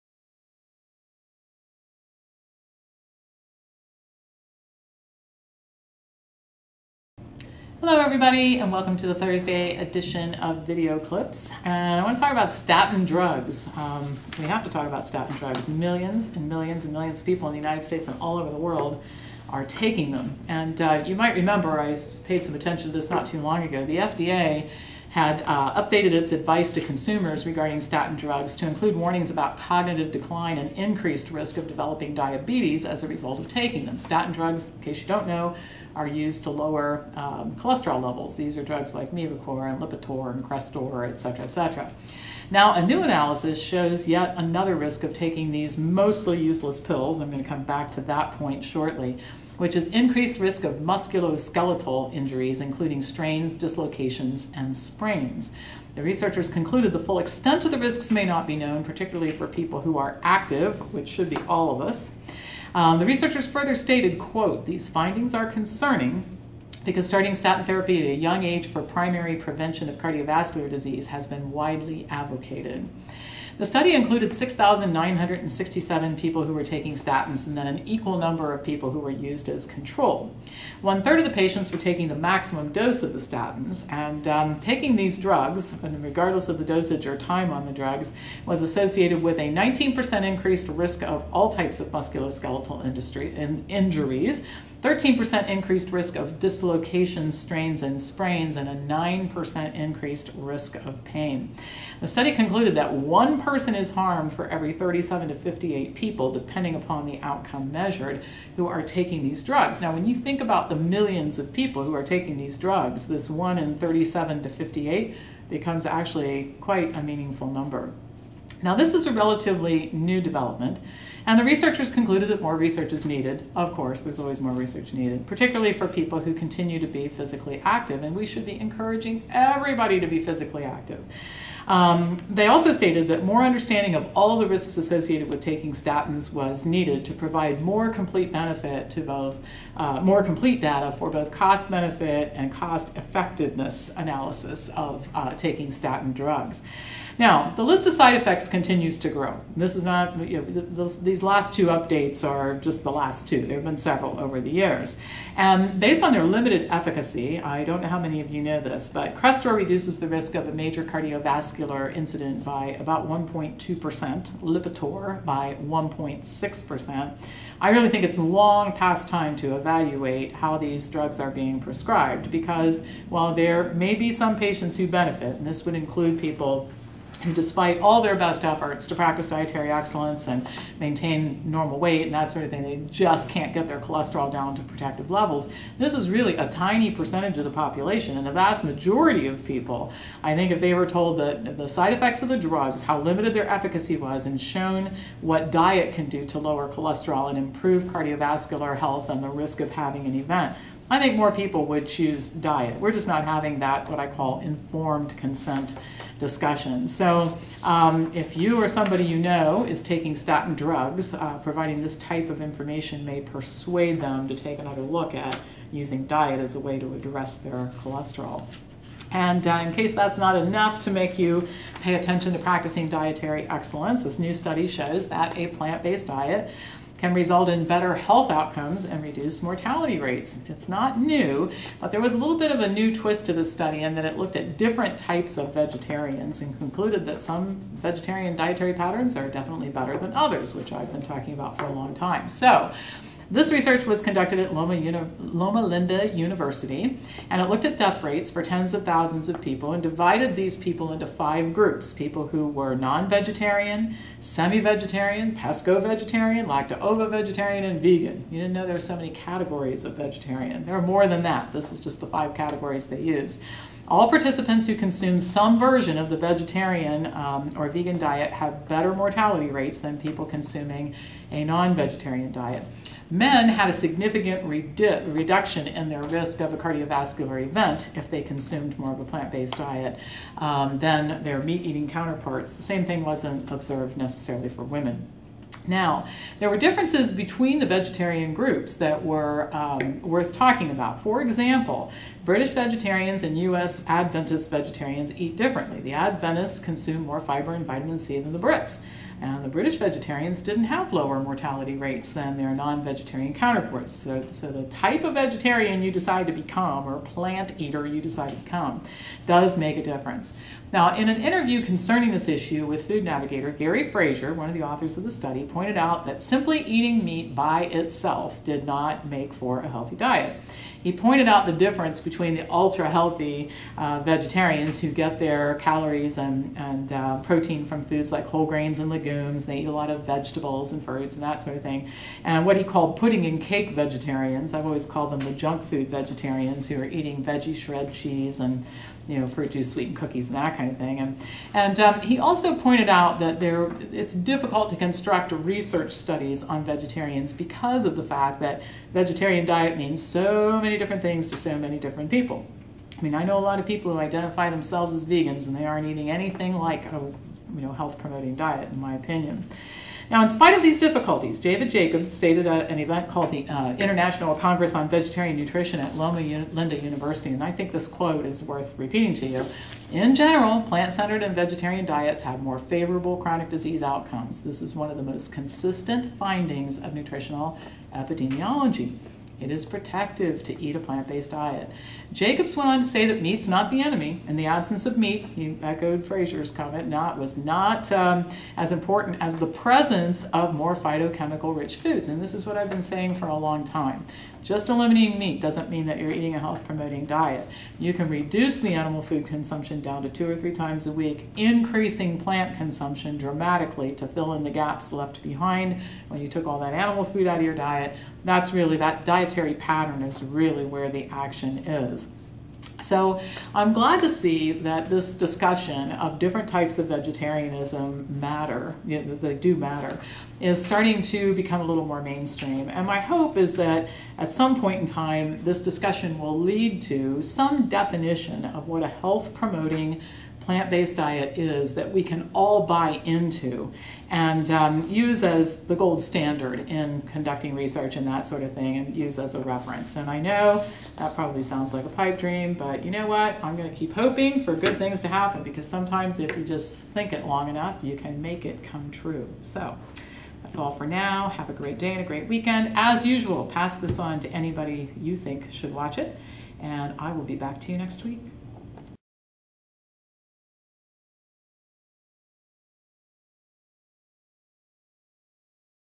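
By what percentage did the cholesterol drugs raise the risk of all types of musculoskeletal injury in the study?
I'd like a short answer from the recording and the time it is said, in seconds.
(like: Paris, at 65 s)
19%, at 89 s.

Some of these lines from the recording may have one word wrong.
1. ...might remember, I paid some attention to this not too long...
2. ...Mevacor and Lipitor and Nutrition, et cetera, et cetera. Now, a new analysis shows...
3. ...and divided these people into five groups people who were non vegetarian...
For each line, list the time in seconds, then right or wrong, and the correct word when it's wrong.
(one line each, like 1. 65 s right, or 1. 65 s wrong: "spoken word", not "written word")
1. 21 s right
2. 39 s wrong: "Crestor", not "Nutrition"
3. 249 s right.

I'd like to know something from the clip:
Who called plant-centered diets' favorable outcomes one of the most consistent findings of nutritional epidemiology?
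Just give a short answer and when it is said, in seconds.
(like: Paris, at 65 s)
David Jacobs, at 361 s.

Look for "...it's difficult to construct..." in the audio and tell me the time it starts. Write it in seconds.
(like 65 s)
343 s.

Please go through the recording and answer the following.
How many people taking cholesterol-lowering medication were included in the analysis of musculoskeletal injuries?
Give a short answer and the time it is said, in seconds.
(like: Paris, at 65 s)
6,967, at 74 s.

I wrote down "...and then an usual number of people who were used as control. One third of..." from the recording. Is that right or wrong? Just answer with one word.
wrong.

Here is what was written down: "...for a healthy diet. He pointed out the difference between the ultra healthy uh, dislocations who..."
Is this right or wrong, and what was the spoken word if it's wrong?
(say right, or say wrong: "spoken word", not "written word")
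wrong: "vegetarians", not "dislocations".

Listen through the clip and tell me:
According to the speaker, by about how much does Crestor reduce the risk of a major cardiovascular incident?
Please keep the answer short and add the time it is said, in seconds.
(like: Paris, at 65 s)
1.2%, at 163 s.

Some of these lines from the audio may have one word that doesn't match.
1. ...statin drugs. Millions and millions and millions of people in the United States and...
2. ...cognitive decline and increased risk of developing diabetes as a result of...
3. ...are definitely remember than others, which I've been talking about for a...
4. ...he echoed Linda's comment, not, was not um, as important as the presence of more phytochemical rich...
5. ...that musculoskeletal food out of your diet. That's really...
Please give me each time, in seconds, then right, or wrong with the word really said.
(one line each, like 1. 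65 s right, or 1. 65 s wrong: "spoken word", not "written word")
1. 15 s right
2. 29 s right
3. 239 s wrong: "better", not "remember"
4. 385 s wrong: "Fraser", not "Linda"
5. 406 s wrong: "animal", not "musculoskeletal".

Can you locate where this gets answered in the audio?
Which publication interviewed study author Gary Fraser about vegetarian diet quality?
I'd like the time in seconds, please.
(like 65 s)
312 s.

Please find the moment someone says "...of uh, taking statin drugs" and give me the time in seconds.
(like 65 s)
144 s.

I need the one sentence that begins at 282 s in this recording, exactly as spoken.
The same thing wasn't observed necessarily for women.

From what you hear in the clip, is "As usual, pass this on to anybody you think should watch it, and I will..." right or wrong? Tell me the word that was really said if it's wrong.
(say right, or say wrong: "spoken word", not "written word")
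right.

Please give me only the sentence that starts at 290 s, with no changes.
For example, British vegetarians and U.S.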